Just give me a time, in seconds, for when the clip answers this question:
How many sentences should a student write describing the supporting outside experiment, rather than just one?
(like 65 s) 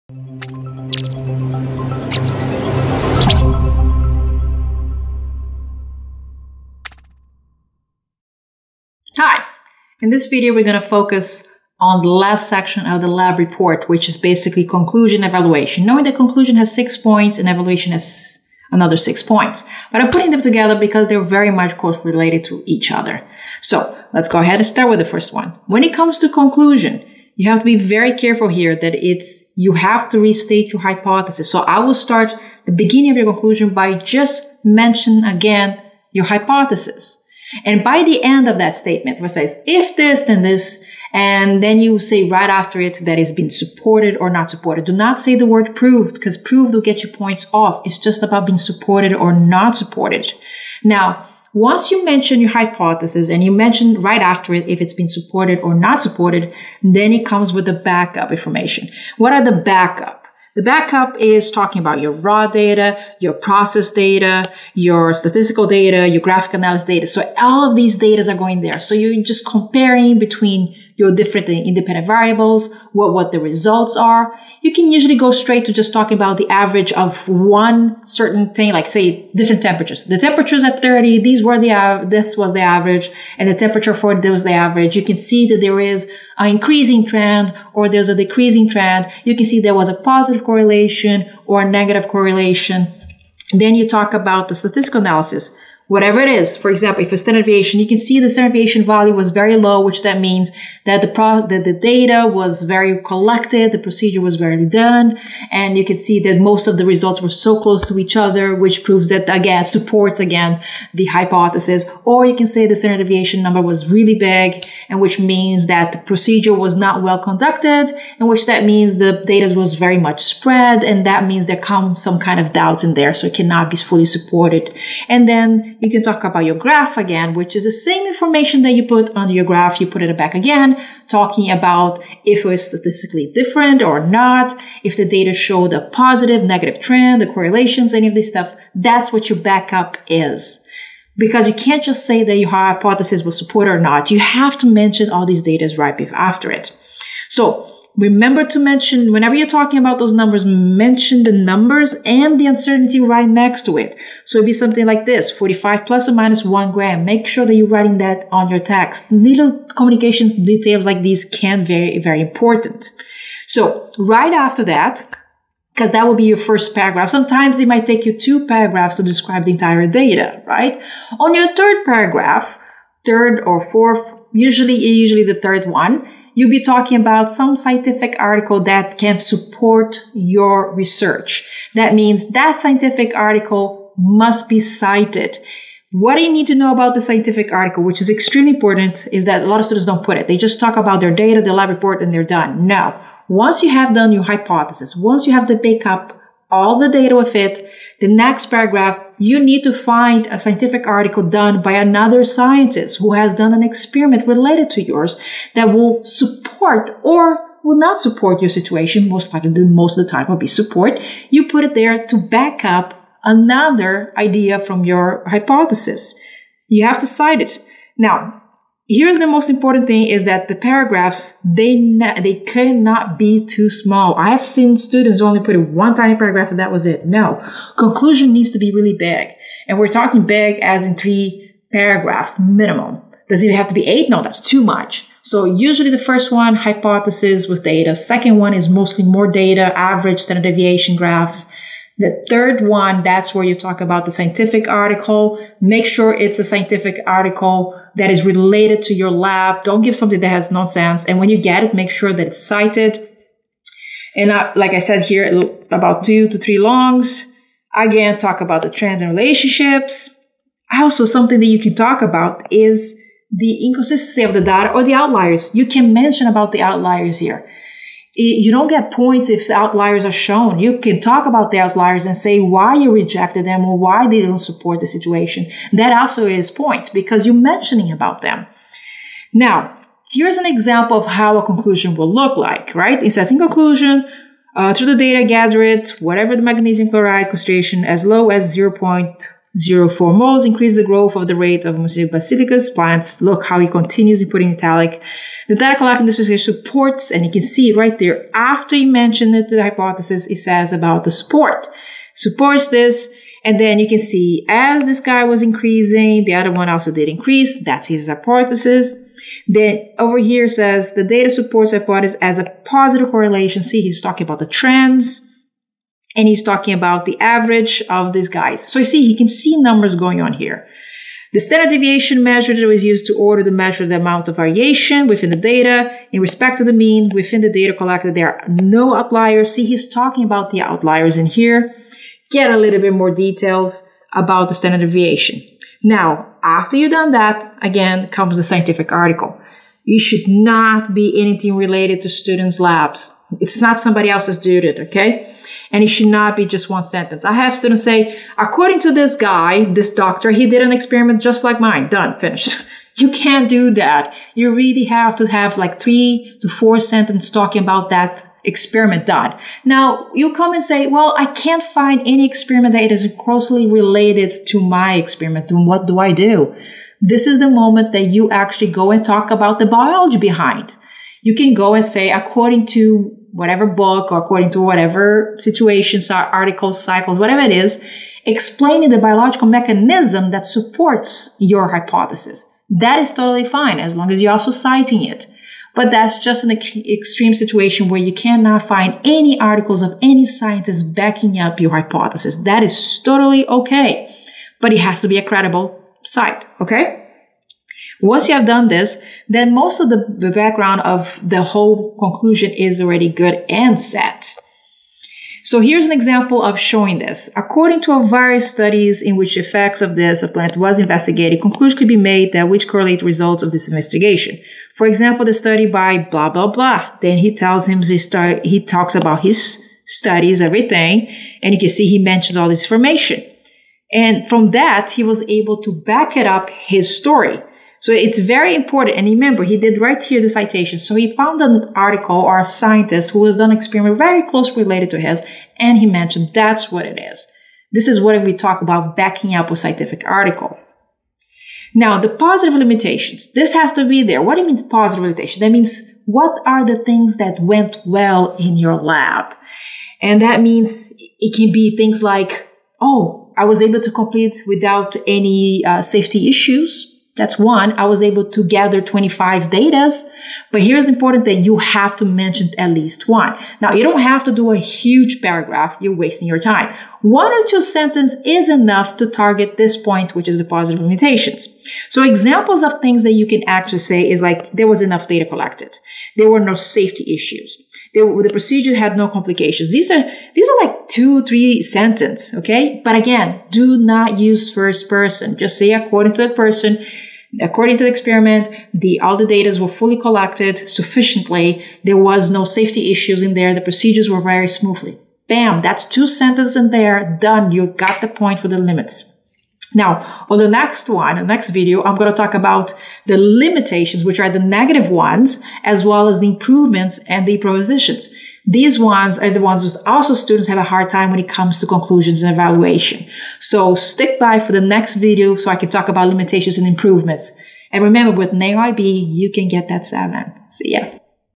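355 s.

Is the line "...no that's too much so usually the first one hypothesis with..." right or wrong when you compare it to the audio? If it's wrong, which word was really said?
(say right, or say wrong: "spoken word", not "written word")
right.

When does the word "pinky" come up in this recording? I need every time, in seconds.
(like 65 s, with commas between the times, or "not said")
not said.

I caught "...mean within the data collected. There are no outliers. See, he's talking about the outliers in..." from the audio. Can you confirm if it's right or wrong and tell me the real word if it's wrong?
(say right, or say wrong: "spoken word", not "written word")
right.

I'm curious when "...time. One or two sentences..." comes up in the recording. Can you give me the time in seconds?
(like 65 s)
466 s.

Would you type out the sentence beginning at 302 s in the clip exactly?
Supports this, and then you can see as this guy was increasing, the other one also did increase.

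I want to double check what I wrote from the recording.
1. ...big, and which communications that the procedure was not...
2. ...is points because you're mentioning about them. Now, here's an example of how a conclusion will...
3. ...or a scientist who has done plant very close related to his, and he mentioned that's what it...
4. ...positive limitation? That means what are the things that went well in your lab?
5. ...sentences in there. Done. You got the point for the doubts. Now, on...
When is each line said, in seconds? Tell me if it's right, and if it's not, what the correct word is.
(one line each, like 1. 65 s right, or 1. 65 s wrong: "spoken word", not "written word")
1. 114 s wrong: "means", not "communications"
2. 276 s right
3. 432 s wrong: "experiment", not "plant"
4. 444 s right
5. 496 s wrong: "limits", not "doubts".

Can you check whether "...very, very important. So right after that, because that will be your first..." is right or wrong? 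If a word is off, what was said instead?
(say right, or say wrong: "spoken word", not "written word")
right.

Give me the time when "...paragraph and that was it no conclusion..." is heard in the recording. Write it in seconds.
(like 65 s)
226 s.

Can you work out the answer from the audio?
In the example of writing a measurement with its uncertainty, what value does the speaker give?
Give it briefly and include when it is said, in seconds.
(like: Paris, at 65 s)
45 ± 1 gram, at 155 s.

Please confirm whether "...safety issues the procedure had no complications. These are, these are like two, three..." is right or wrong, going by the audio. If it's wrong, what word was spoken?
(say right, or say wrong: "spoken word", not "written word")
right.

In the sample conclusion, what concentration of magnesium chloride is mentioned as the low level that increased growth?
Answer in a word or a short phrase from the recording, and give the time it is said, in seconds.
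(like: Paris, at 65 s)
0.04 moles, at 289 s.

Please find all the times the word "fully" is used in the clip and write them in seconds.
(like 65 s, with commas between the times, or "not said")
123 s, 489 s.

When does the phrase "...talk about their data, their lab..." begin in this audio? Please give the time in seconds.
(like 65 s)
190 s.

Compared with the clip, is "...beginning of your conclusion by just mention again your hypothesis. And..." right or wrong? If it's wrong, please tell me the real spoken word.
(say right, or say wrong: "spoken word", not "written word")
right.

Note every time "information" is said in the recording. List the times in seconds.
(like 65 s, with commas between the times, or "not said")
58 s, 128 s, 422 s.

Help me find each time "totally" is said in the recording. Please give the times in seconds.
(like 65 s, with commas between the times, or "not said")
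383 s, 393 s.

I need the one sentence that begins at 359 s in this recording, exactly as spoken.
Now you come and say, well, I can't find any experiment that is closely related to my experiment.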